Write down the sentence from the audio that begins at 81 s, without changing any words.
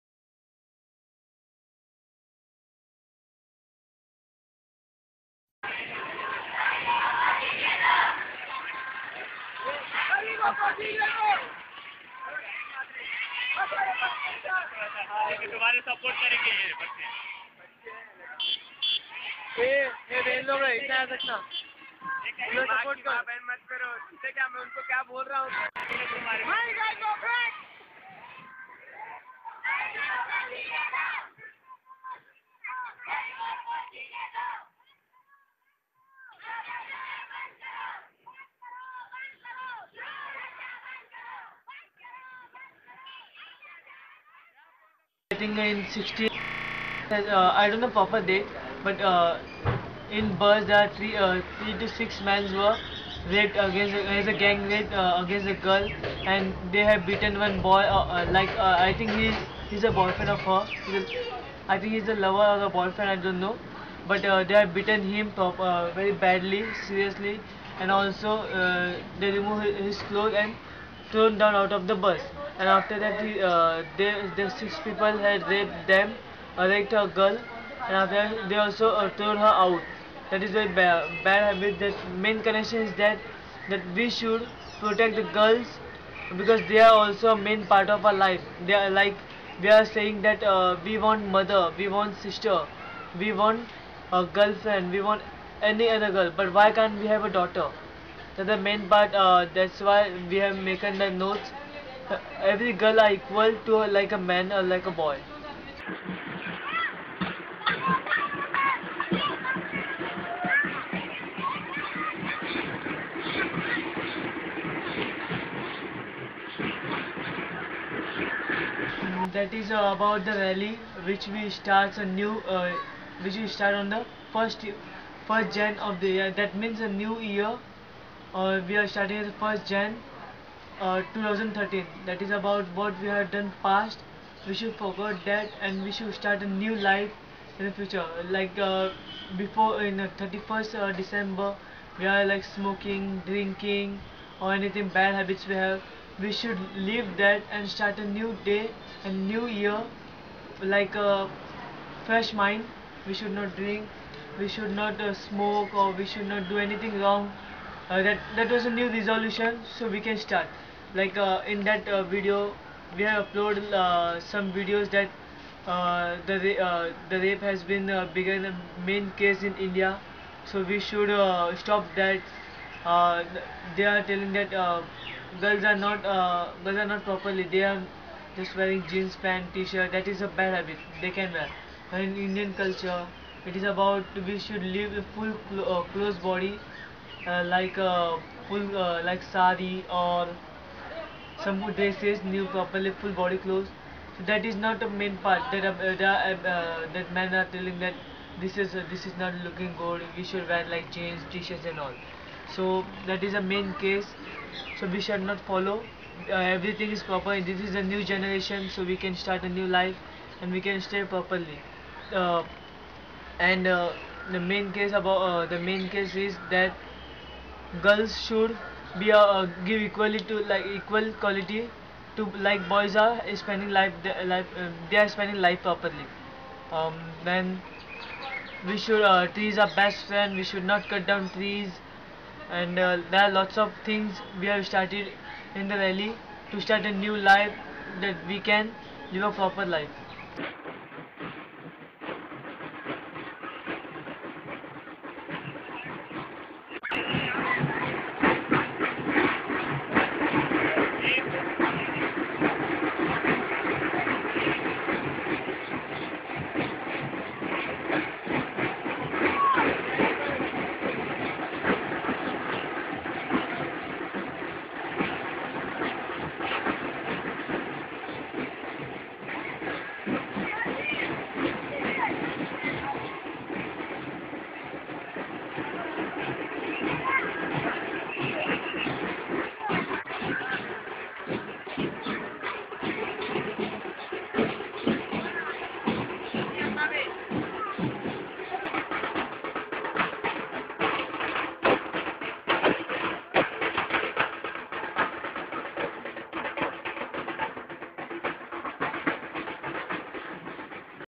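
The main connection is that that we should protect the girls because they are also a main part of our life.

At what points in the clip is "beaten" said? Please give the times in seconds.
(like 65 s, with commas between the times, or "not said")
57 s, 64 s.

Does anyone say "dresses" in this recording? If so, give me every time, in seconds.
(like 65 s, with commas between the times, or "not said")
191 s.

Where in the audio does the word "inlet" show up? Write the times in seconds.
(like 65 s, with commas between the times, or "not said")
not said.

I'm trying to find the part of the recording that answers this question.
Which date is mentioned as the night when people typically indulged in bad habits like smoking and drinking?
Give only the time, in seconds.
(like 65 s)
140 s.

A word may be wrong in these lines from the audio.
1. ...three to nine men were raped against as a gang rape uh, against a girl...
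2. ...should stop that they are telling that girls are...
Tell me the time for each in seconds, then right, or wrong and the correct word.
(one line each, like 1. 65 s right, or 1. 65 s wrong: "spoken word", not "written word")
1. 51 s wrong: "six", not "nine"
2. 170 s right.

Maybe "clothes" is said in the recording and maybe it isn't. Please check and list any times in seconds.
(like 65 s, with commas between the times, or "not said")
70 s, 193 s.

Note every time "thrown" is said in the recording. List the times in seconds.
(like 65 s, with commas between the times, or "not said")
71 s, 79 s.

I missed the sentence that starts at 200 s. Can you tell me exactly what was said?
We should wear like jeans, t-shirts and all.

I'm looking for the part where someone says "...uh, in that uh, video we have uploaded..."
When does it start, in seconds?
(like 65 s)
161 s.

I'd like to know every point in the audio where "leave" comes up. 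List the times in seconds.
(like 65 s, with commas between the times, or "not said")
146 s.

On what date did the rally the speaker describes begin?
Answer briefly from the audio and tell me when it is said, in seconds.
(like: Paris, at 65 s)
1 January 2013, at 129 s.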